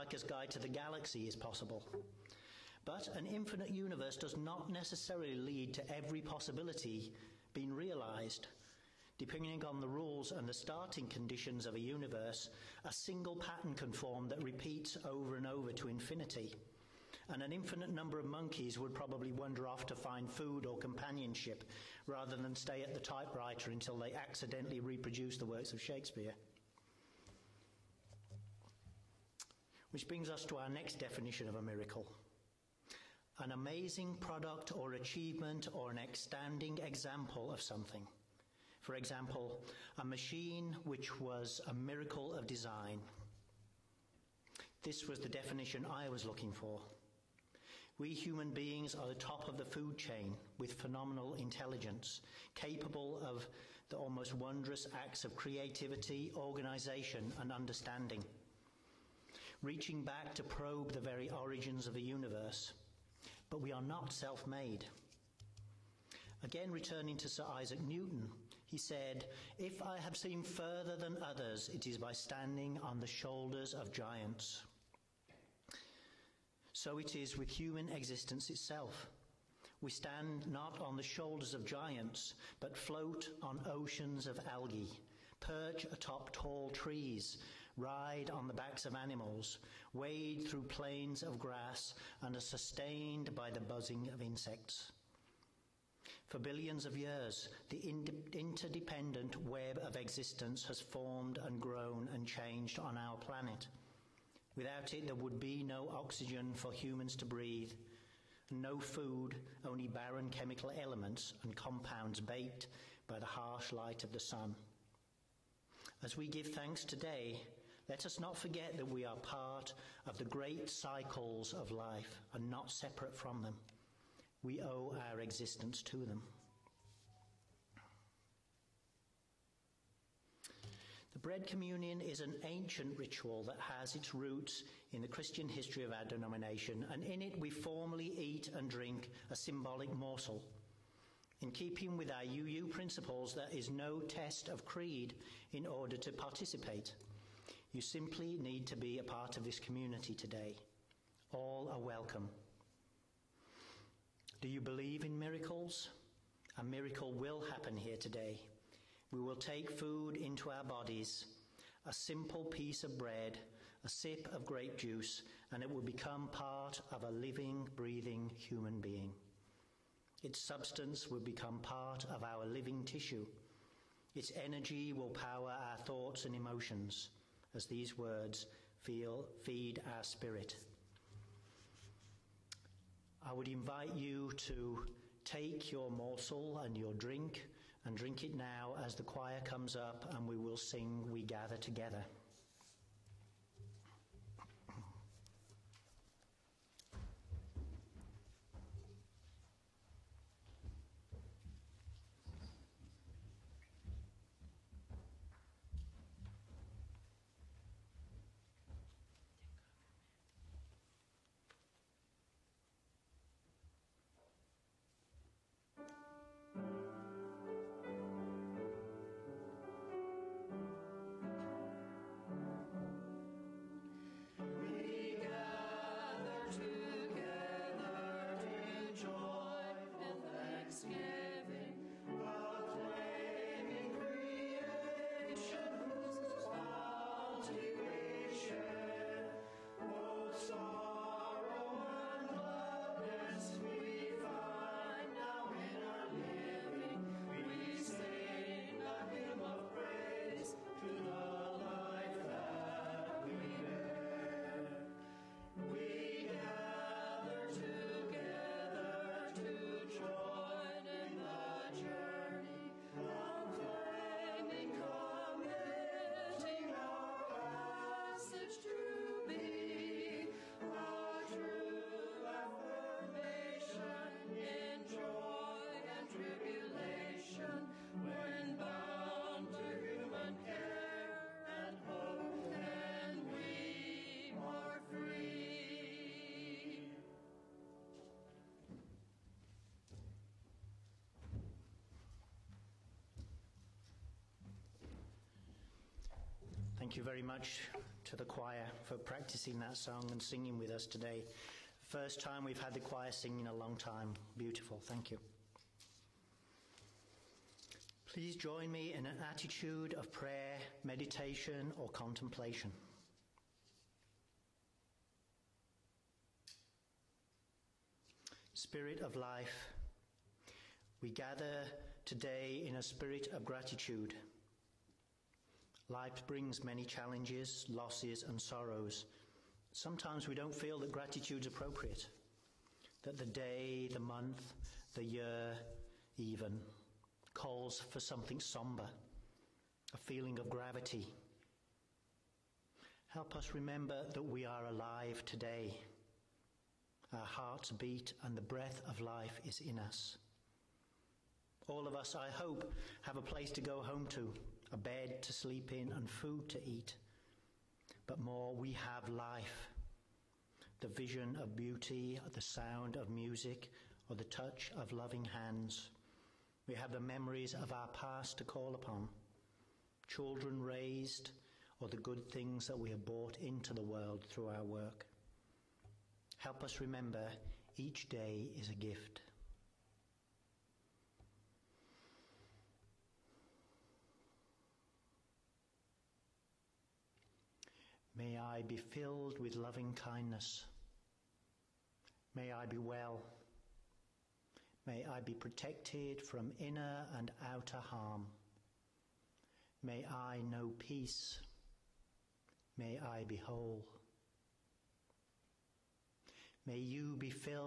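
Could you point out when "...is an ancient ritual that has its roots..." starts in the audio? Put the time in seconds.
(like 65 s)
132 s.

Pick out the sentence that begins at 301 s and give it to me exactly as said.
First time we've had the choir singing in a long time.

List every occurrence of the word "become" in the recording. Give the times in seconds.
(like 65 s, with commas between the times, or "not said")
165 s, 171 s.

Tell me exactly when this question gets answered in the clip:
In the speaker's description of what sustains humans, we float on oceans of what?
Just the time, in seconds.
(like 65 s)
84 s.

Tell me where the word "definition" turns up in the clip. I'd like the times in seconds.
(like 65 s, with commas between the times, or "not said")
30 s, 45 s.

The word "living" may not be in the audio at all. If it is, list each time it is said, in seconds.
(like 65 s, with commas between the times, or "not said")
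167 s, 172 s.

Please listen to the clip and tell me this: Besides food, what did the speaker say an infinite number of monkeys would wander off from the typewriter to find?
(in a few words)
companionship.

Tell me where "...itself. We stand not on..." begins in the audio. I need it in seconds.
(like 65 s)
78 s.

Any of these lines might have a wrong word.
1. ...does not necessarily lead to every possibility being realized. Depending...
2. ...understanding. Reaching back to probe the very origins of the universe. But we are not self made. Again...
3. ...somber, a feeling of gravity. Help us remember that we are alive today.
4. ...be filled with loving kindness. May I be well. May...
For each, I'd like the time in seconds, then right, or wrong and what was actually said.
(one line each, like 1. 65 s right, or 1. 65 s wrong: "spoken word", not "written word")
1. 4 s right
2. 57 s right
3. 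338 s right
4. 388 s right.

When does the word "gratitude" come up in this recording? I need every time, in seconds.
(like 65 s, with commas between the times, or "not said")
323 s, 330 s.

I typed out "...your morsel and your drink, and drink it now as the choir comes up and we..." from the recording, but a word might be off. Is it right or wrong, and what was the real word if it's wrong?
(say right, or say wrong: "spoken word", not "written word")
right.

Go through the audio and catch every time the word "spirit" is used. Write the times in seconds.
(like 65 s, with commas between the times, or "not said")
180 s, 318 s, 322 s.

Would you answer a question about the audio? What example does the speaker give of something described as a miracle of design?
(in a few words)
a machine.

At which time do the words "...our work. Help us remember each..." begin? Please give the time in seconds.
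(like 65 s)
374 s.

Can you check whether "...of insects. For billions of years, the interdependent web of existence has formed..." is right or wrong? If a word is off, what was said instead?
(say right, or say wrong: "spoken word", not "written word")
right.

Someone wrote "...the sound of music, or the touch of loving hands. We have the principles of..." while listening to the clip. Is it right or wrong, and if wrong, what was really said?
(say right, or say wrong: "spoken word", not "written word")
wrong: "memories", not "principles".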